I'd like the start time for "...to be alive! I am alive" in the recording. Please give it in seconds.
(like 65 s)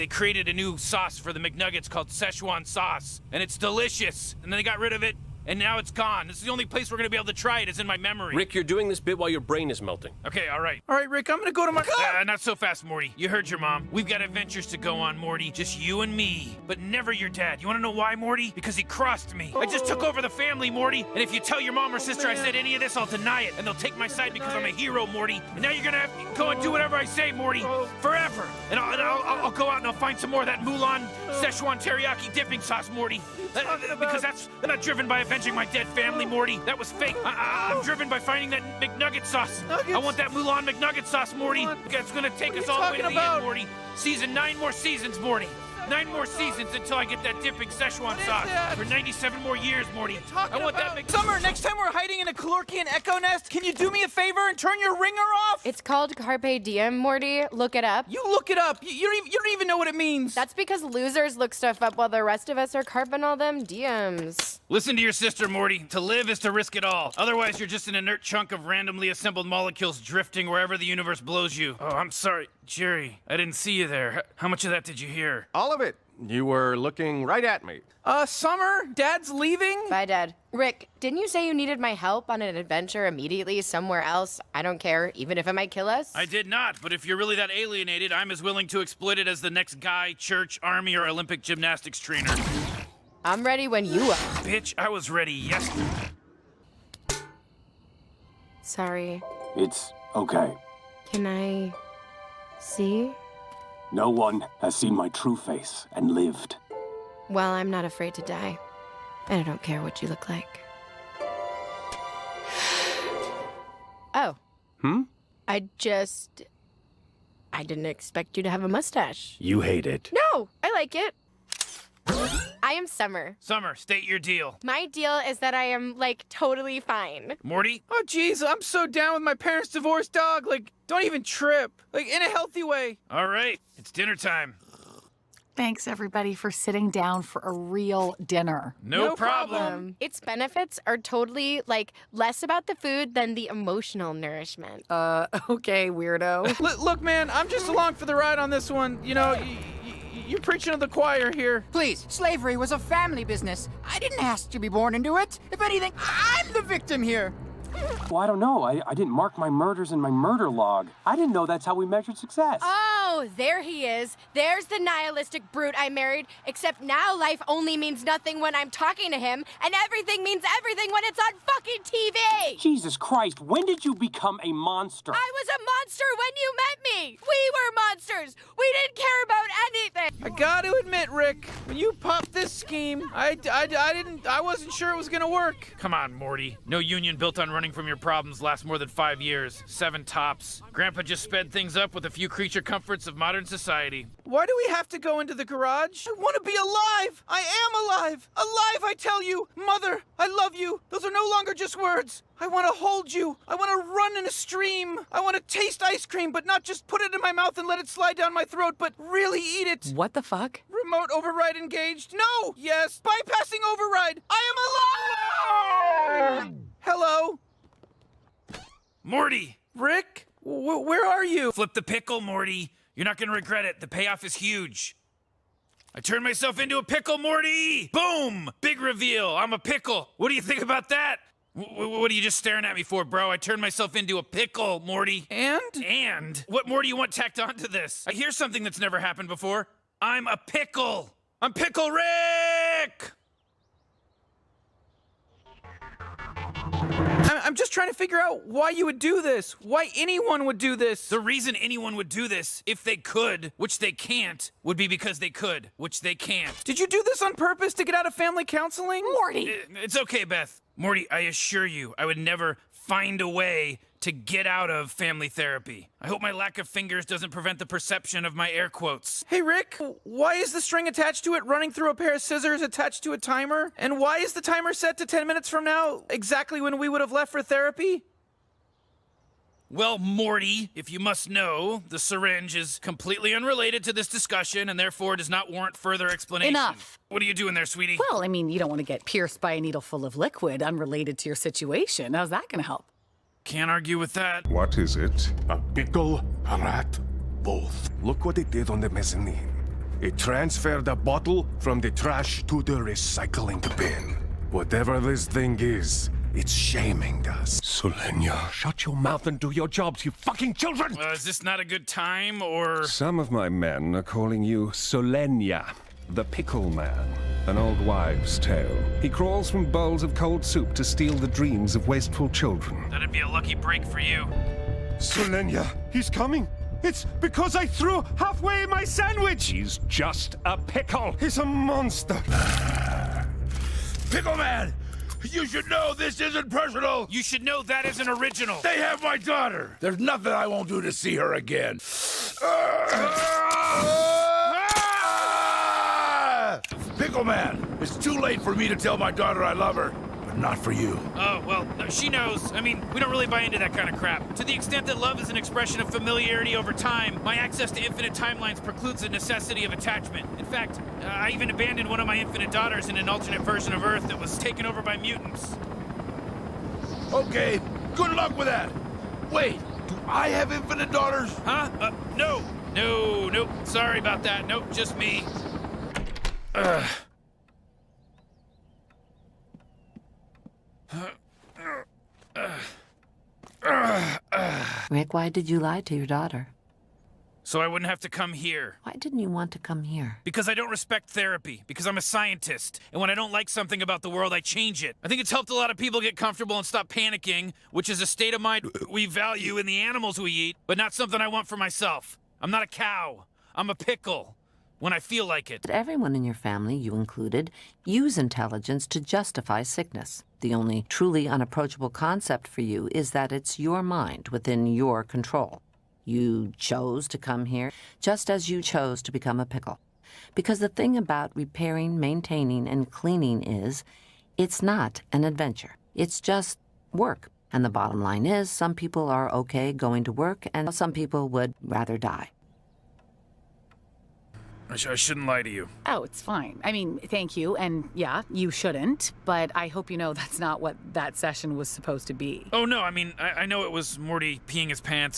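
196 s.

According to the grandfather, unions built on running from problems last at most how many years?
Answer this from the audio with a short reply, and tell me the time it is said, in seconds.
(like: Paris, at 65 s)
7, at 189 s.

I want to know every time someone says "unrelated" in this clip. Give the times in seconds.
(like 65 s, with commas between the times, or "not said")
283 s, 290 s.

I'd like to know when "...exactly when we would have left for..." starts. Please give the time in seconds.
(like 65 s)
276 s.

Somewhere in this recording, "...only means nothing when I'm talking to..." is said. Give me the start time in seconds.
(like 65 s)
167 s.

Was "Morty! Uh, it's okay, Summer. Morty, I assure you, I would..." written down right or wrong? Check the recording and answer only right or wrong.
wrong.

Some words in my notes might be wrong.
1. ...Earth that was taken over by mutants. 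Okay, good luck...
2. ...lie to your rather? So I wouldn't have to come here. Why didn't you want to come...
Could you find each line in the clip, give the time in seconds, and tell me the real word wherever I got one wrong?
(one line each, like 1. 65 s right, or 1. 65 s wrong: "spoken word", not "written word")
1. 363 s right
2. 385 s wrong: "daughter", not "rather".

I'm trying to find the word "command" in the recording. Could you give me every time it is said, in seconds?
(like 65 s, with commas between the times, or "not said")
not said.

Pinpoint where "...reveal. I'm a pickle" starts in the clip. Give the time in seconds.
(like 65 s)
228 s.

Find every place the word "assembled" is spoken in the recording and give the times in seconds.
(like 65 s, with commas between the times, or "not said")
69 s.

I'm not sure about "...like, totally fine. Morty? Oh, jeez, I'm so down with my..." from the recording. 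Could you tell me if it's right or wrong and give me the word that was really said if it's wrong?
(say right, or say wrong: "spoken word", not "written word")
right.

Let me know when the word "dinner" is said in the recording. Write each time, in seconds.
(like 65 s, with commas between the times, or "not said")
133 s, 138 s.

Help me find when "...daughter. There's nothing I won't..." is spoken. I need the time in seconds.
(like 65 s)
339 s.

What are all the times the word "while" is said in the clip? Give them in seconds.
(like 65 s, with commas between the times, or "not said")
9 s, 61 s.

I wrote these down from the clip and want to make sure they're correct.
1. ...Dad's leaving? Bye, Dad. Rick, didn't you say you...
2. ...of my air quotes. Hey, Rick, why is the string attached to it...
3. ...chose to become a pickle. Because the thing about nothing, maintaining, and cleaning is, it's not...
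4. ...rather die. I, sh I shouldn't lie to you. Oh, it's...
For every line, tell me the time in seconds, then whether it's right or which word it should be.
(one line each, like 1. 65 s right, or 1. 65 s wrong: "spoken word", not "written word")
1. 78 s right
2. 268 s right
3. 418 s wrong: "repairing", not "nothing"
4. 431 s right.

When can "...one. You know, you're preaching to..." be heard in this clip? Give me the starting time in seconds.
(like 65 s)
148 s.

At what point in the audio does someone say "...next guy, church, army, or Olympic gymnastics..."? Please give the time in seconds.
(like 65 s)
89 s.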